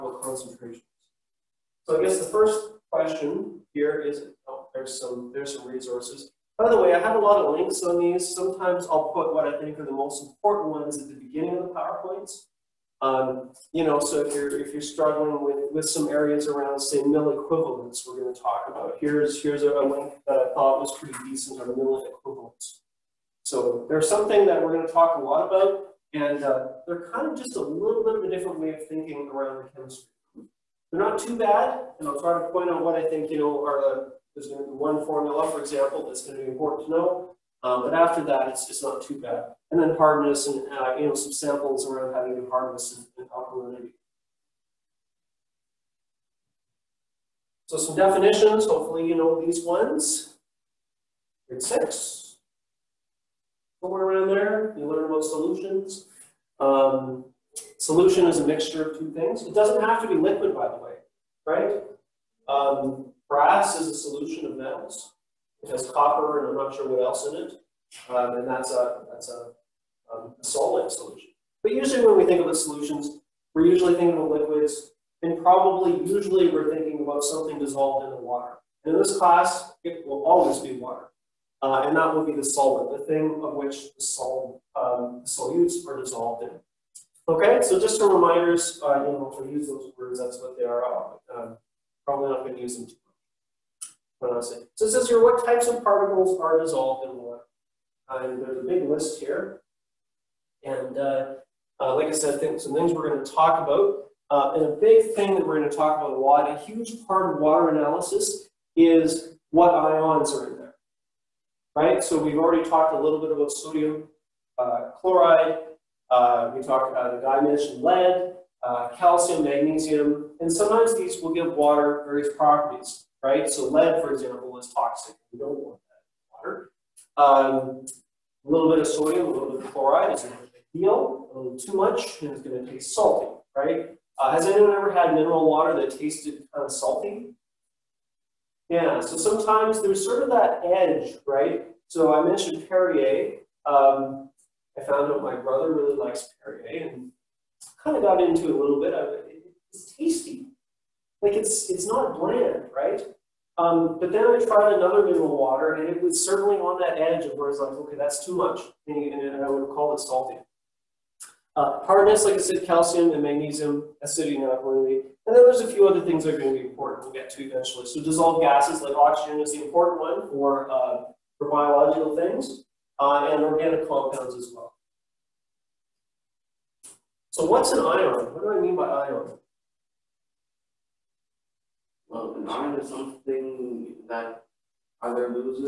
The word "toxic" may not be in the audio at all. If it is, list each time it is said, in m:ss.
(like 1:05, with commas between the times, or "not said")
2:04.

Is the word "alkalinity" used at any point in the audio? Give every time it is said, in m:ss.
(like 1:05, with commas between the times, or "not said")
0:43, 2:44.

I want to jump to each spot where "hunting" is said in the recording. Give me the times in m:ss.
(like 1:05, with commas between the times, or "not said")
not said.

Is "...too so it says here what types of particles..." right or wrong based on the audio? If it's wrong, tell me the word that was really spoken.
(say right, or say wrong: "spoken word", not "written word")
right.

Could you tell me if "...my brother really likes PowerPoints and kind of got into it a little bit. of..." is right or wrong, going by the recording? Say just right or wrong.
wrong.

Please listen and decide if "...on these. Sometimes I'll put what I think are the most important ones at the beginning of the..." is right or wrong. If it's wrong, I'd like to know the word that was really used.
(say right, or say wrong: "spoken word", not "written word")
right.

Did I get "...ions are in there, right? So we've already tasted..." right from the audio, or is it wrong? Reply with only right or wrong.
wrong.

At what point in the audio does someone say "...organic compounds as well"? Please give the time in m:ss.
2:53.